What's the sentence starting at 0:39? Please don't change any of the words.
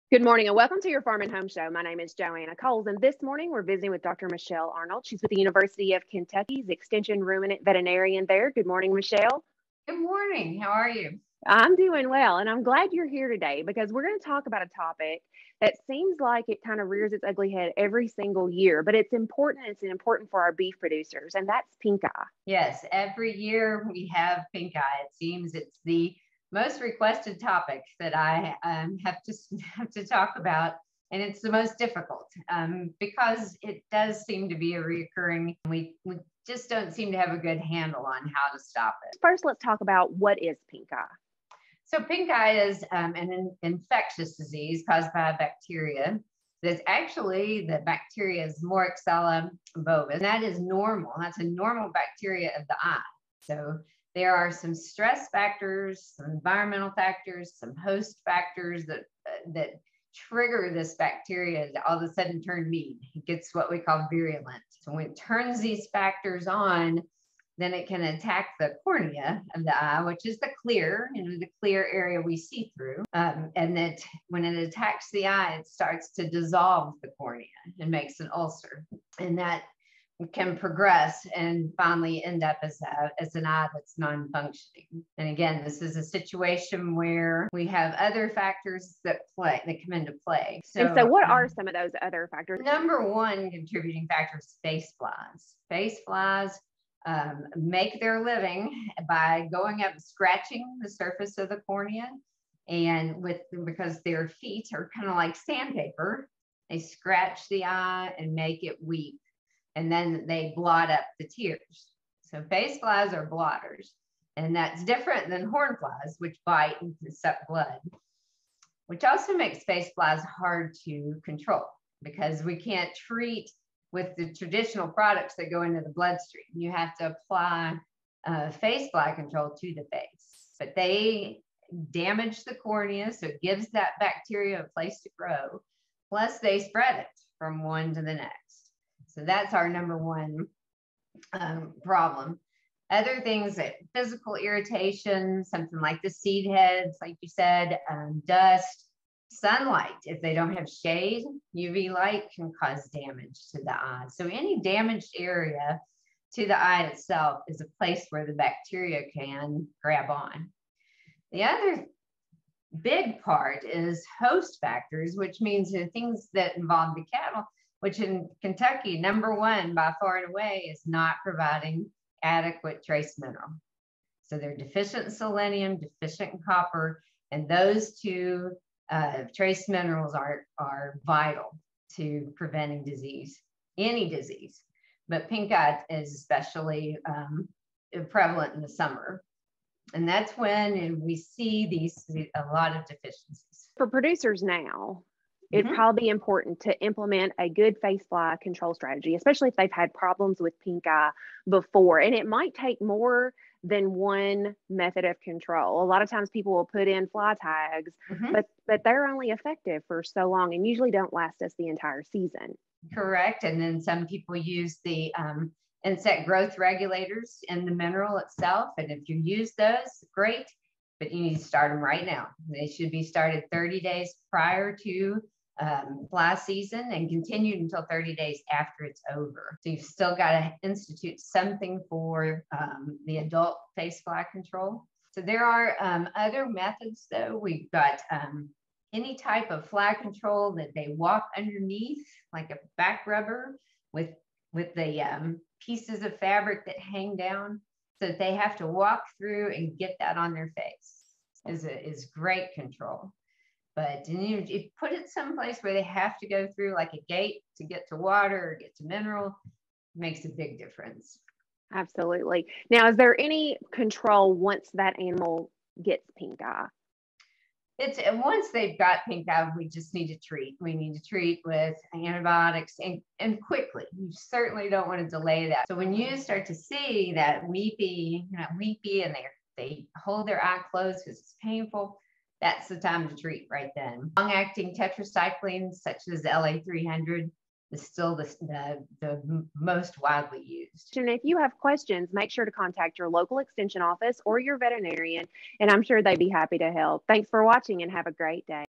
First, let's talk about what is pink eye.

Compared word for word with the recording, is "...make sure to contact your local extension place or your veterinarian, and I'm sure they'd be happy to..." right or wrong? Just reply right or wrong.
wrong.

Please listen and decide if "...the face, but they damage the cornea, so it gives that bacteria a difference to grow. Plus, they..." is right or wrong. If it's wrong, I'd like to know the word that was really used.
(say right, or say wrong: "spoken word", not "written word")
wrong: "place", not "difference".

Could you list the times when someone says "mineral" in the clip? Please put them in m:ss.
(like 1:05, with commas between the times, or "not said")
2:53, 2:59, 3:37, 4:18.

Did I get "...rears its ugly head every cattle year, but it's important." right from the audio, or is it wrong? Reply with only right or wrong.
wrong.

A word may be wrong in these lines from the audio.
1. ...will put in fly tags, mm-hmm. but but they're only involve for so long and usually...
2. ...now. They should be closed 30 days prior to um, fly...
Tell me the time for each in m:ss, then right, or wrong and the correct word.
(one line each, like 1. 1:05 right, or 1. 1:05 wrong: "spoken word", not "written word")
1. 3:26 wrong: "effective", not "involve"
2. 3:42 wrong: "started", not "closed".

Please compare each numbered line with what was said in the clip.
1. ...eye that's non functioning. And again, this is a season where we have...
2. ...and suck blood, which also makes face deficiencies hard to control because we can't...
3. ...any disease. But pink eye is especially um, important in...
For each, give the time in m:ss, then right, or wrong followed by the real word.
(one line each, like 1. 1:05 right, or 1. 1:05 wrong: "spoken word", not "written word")
1. 1:23 wrong: "situation", not "season"
2. 1:56 wrong: "flies", not "deficiencies"
3. 3:03 wrong: "prevalent", not "important".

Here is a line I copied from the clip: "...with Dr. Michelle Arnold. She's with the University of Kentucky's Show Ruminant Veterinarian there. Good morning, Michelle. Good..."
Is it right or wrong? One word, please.
wrong.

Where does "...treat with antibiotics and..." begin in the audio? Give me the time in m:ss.
4:31.